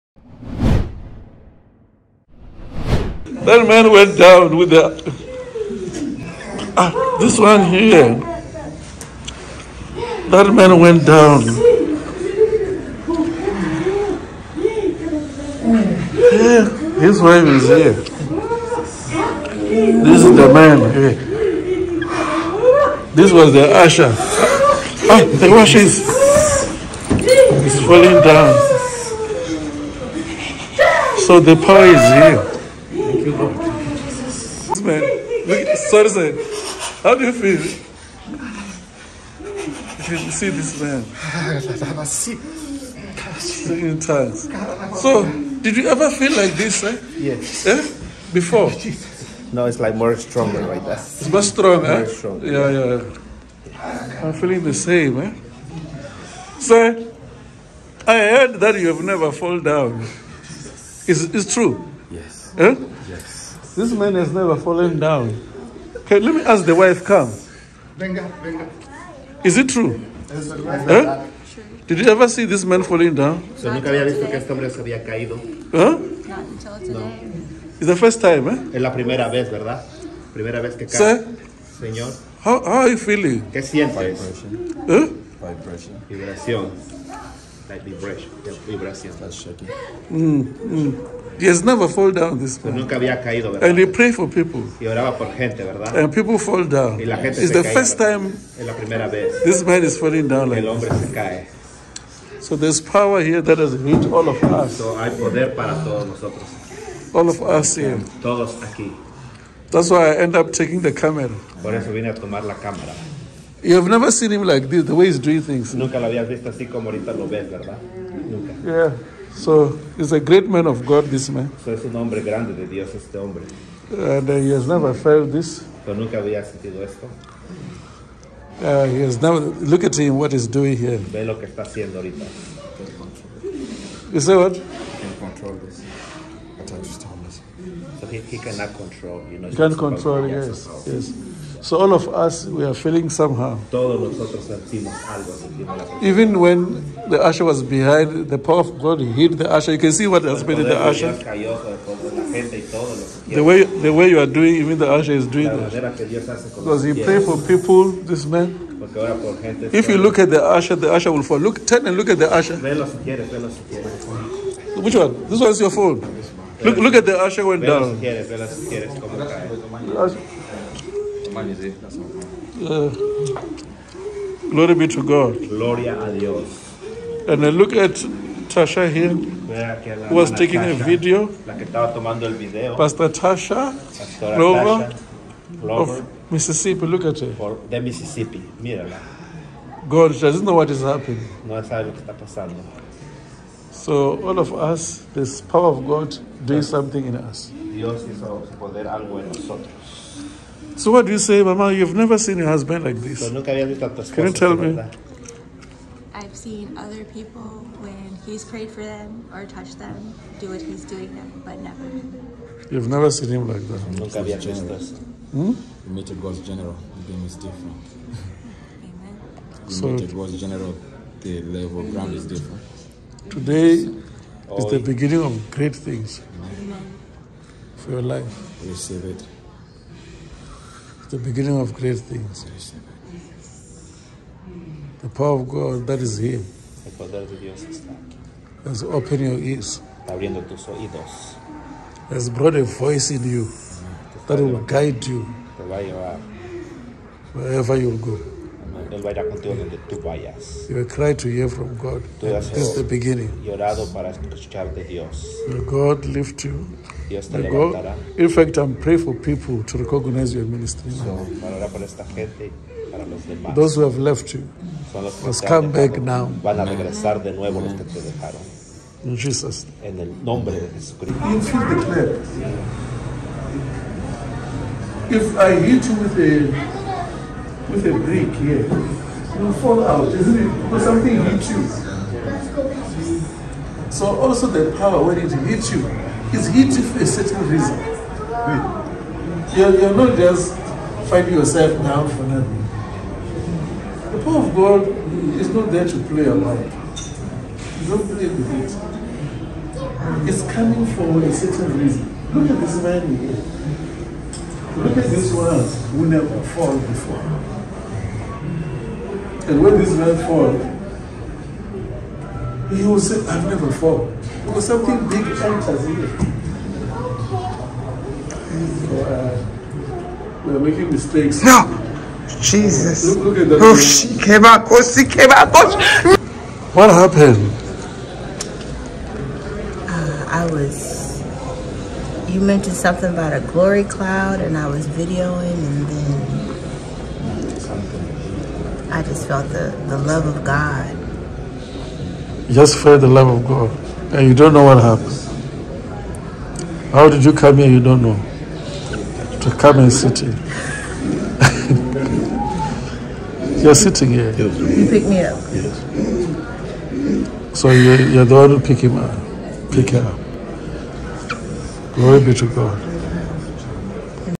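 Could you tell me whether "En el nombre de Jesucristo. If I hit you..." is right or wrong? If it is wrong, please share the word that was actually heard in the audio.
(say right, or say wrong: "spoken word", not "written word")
right.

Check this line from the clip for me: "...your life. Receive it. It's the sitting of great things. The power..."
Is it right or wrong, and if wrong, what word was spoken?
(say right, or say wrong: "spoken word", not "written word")
wrong: "beginning", not "sitting".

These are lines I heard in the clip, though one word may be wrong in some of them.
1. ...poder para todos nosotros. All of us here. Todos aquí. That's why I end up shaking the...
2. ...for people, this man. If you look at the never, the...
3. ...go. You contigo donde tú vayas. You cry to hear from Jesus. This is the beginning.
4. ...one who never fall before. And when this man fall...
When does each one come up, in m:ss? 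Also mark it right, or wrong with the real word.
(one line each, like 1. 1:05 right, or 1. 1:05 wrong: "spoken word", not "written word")
1. 1:45 wrong: "taking", not "shaking"
2. 2:37 wrong: "usher", not "never"
3. 4:07 wrong: "God", not "Jesus"
4. 5:05 right.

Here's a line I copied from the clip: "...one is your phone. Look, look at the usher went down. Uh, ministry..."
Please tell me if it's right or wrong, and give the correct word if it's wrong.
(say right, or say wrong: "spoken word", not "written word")
wrong: "glory", not "ministry".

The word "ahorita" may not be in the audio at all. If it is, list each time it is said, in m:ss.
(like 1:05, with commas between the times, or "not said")
1:56, 2:11.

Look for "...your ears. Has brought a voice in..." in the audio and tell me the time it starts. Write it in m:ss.
3:59.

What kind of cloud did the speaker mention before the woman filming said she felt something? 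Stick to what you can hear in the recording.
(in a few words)
glory cloud.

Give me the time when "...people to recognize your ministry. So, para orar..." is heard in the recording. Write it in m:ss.
4:19.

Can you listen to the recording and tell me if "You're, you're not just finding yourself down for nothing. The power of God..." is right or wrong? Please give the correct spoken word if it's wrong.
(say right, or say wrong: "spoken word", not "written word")
right.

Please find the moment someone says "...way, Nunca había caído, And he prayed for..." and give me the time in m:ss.
1:32.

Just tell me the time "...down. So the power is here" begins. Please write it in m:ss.
0:28.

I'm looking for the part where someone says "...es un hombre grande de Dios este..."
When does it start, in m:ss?
2:01.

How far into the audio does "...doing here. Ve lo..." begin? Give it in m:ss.
2:10.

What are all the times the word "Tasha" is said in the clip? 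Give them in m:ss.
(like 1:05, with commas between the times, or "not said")
2:58, 3:03.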